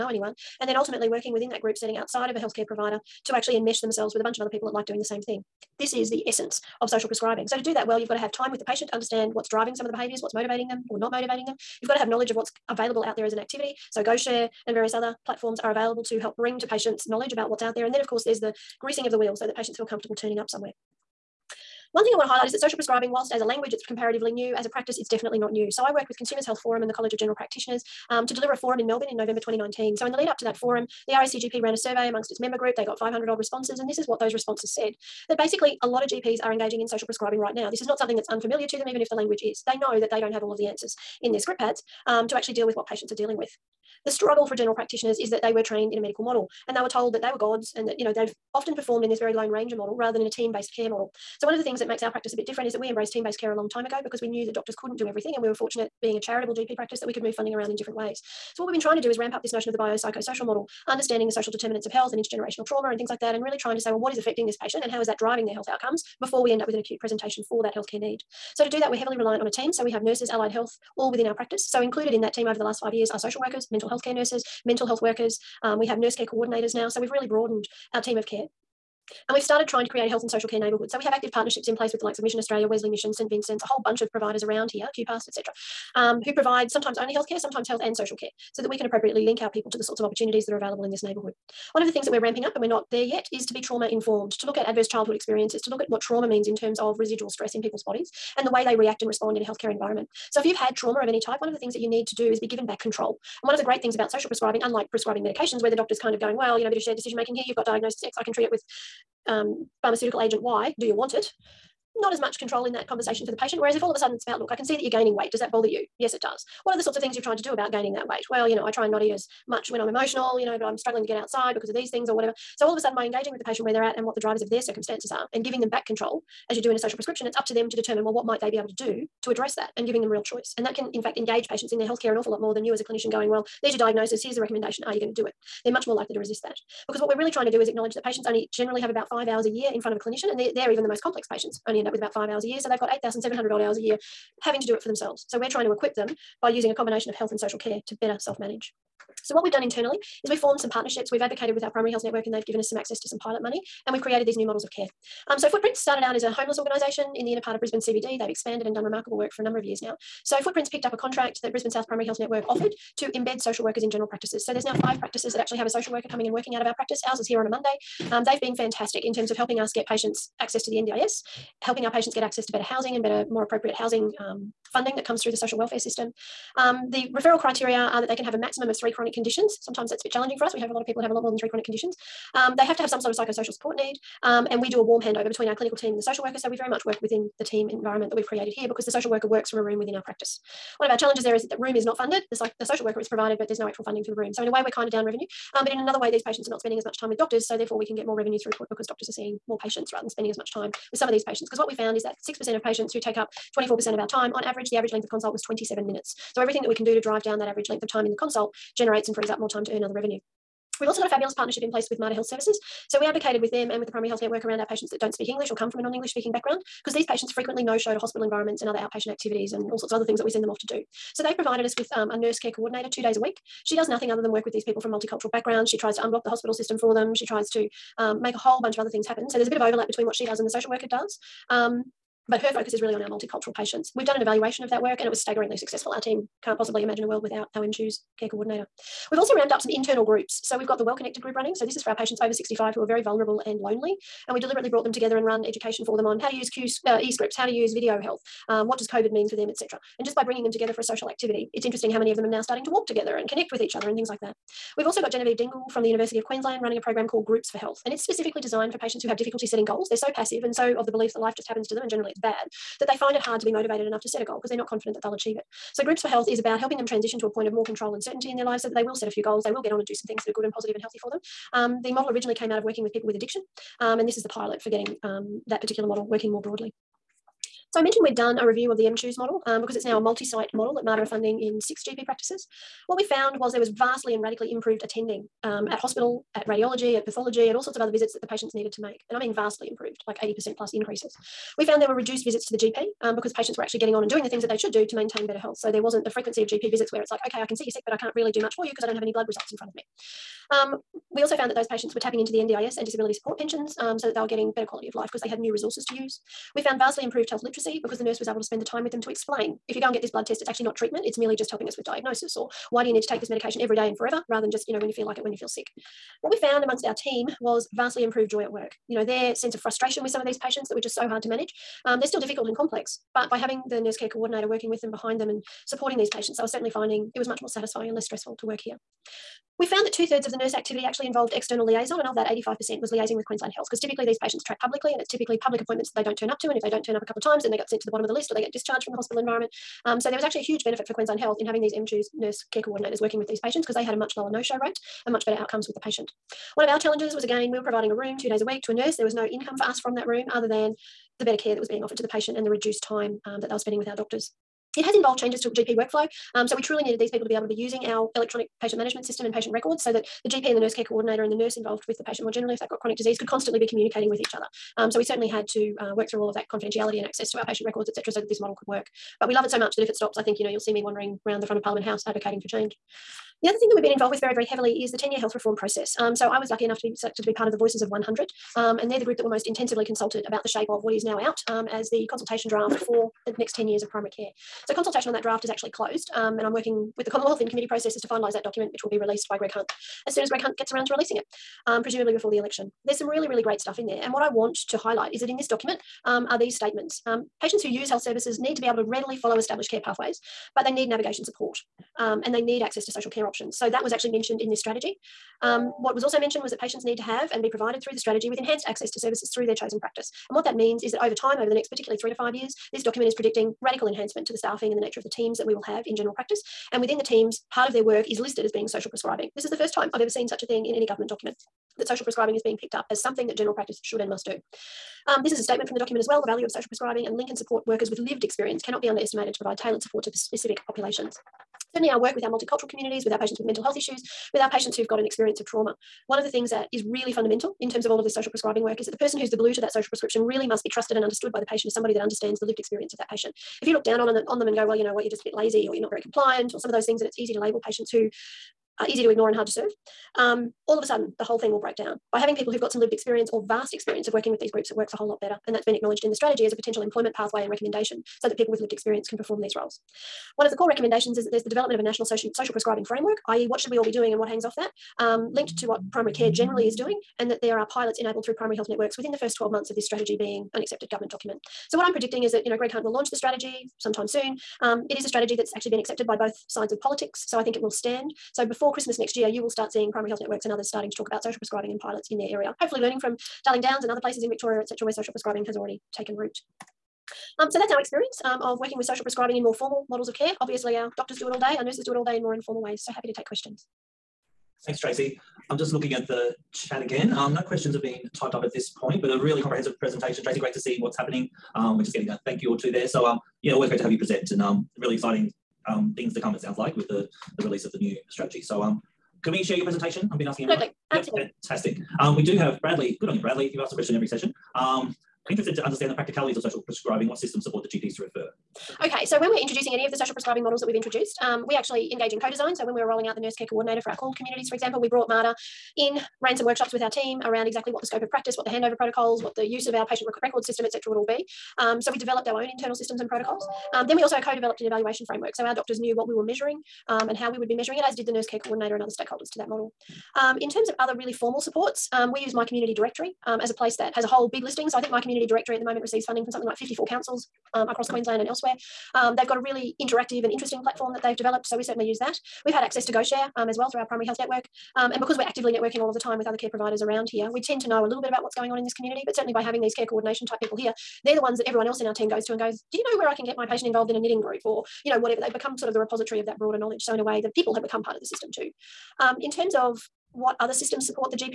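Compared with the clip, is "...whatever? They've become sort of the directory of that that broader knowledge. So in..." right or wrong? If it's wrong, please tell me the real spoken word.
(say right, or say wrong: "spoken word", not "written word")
wrong: "repository", not "directory".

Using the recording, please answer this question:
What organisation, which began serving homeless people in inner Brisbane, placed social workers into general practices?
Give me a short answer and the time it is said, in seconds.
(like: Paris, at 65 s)
Footprints, at 155 s.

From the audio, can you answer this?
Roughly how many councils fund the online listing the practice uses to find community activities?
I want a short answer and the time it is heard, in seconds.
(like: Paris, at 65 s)
54, at 546 s.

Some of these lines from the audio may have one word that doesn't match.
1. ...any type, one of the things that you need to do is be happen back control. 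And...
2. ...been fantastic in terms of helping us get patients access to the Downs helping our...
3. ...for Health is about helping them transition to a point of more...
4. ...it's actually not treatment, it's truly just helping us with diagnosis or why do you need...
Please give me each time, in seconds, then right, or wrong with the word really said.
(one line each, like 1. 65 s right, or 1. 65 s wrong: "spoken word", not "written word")
1. 101 s wrong: "given", not "happen"
2. 168 s wrong: "NDIS", not "Downs"
3. 266 s right
4. 310 s wrong: "merely", not "truly".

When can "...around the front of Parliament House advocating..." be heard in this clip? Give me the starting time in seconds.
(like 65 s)
371 s.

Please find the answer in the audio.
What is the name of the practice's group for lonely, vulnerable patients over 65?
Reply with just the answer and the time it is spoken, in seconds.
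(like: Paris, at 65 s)
Well Connected, at 240 s.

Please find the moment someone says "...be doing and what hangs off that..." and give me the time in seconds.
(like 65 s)
463 s.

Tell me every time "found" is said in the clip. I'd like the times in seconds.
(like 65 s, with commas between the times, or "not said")
201 s, 283 s, 291 s, 301 s, 306 s, 316 s, 329 s.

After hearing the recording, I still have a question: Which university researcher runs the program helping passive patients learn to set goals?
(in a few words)
Genevieve Dingle.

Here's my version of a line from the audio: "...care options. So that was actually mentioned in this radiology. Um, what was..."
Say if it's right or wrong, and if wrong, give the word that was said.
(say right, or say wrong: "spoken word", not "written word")
wrong: "strategy", not "radiology".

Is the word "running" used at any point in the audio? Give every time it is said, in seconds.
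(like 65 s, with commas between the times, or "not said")
241 s, 256 s.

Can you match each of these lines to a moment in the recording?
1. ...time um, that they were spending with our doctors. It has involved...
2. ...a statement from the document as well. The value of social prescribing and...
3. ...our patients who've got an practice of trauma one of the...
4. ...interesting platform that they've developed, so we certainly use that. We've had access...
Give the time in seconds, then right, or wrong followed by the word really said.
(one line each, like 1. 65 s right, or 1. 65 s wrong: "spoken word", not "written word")
1. 352 s right
2. 425 s right
3. 434 s wrong: "experience", not "practice"
4. 550 s right.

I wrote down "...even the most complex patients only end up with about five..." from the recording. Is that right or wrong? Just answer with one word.
right.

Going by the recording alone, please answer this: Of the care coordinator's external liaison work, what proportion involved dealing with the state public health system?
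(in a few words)
85%.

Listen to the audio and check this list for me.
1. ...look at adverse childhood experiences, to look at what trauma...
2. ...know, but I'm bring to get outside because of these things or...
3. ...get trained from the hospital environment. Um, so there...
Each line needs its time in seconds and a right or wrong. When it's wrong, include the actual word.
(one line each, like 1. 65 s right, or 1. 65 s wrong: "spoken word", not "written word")
1. 94 s right
2. 120 s wrong: "struggling", not "bring"
3. 338 s wrong: "discharged", not "trained".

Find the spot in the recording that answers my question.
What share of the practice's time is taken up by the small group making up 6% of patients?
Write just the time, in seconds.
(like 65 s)
203 s.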